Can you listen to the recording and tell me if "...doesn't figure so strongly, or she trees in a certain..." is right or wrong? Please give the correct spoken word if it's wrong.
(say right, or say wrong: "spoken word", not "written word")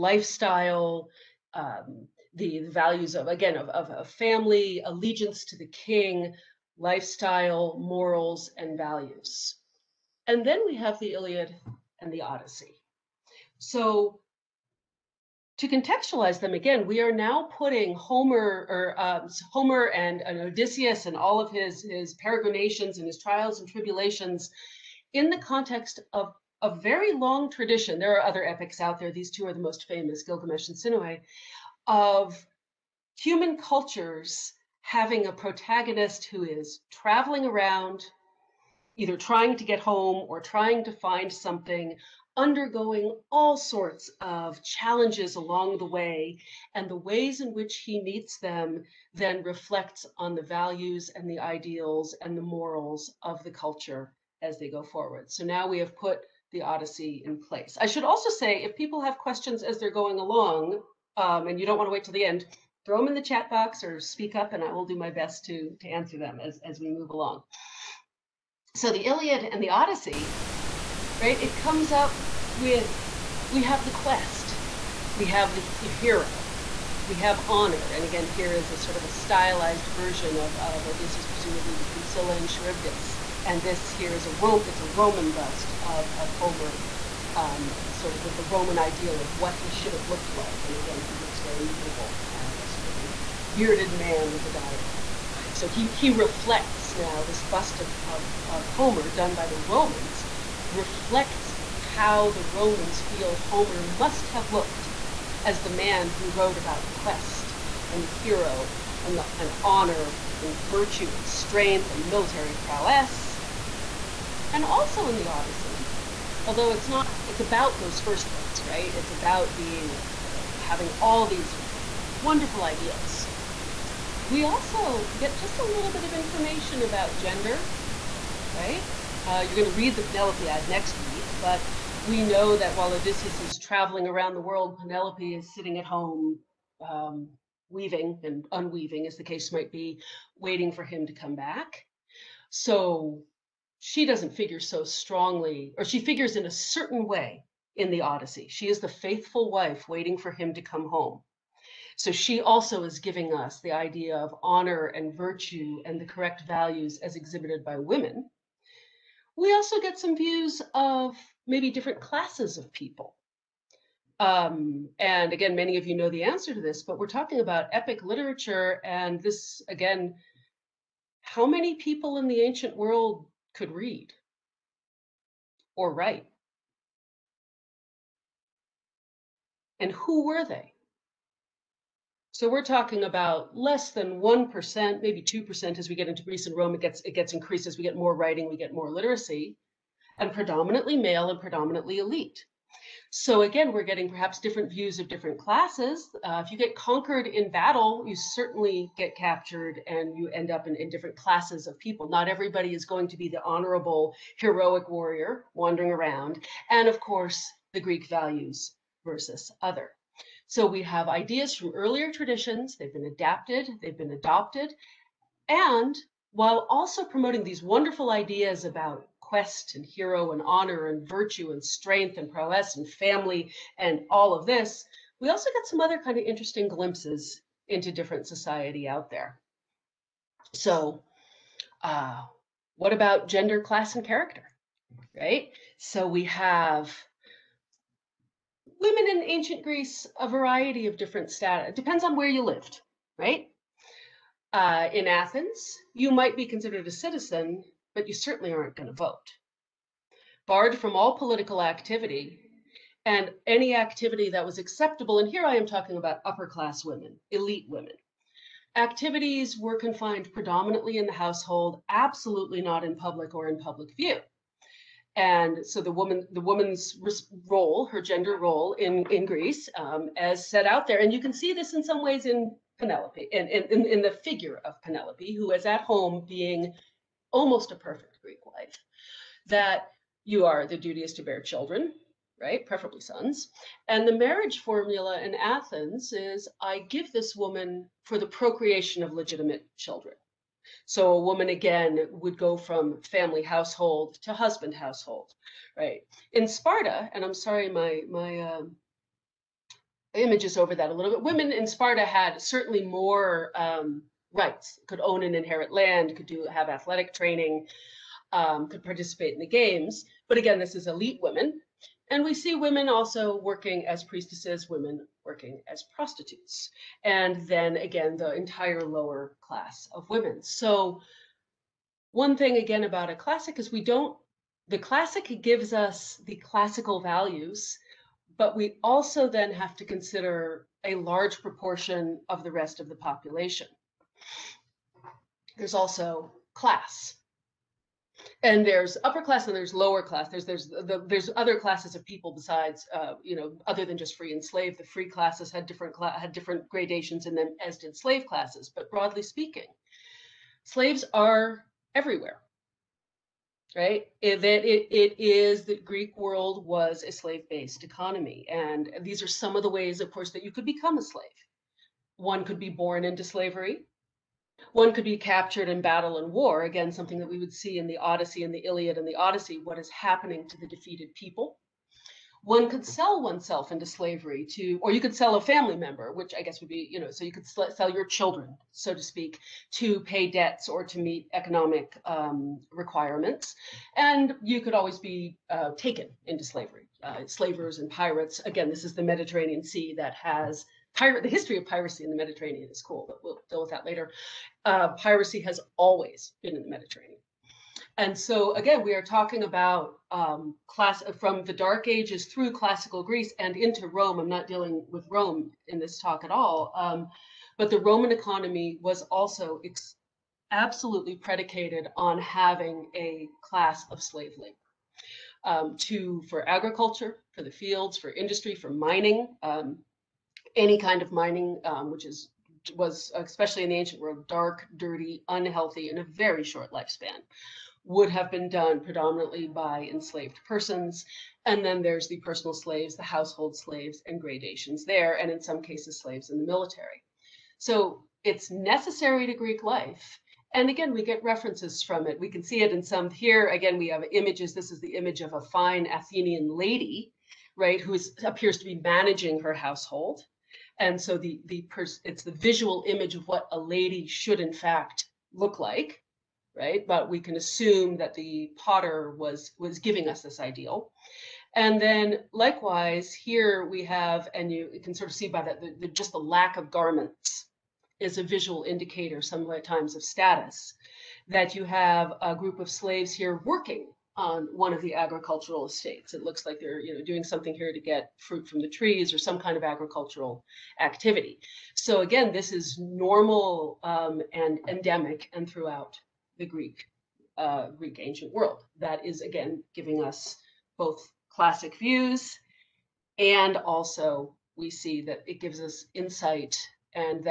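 wrong: "figures", not "trees".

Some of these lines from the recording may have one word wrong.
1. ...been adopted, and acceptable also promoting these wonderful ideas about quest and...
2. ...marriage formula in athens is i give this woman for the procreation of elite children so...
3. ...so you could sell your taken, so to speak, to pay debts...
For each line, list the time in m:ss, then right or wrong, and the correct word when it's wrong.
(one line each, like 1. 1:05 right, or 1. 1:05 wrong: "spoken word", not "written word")
1. 3:33 wrong: "while", not "acceptable"
2. 4:44 wrong: "legitimate", not "elite"
3. 6:17 wrong: "children", not "taken".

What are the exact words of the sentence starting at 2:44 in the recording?
Um, and again, many of you know the answer to this, but we're talking about epic literature.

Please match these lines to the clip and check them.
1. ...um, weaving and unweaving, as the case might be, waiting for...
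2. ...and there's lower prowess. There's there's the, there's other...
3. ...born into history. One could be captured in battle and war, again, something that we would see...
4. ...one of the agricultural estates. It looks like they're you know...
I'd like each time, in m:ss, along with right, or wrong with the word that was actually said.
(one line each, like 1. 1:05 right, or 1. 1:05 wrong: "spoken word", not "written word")
1. 2:16 right
2. 5:39 wrong: "class", not "prowess"
3. 6:02 wrong: "slavery", not "history"
4. 7:54 right.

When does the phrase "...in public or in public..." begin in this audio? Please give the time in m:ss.
4:22.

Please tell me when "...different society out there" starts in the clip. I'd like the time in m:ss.
3:47.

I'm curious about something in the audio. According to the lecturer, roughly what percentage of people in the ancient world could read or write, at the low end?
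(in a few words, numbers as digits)
less than 1%.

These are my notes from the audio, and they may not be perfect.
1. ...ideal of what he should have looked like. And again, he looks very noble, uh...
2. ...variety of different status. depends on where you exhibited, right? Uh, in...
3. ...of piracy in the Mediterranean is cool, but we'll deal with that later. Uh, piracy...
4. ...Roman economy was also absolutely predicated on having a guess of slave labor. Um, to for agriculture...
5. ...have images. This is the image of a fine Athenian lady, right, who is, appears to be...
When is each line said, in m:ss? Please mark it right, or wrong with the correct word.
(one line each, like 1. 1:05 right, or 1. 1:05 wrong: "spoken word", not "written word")
1. 1:28 right
2. 4:00 wrong: "lived", not "exhibited"
3. 6:31 right
4. 6:47 wrong: "class", not "guess"
5. 7:23 right.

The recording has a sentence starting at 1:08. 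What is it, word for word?
So the Iliad and the Odyssey, right?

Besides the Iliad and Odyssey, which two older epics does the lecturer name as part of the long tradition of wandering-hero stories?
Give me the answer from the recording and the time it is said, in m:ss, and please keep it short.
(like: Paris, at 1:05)
Gilgamesh and Sinuhe, at 0:30.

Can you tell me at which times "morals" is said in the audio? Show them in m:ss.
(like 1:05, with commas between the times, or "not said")
0:07, 0:52.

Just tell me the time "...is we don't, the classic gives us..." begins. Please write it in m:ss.
5:23.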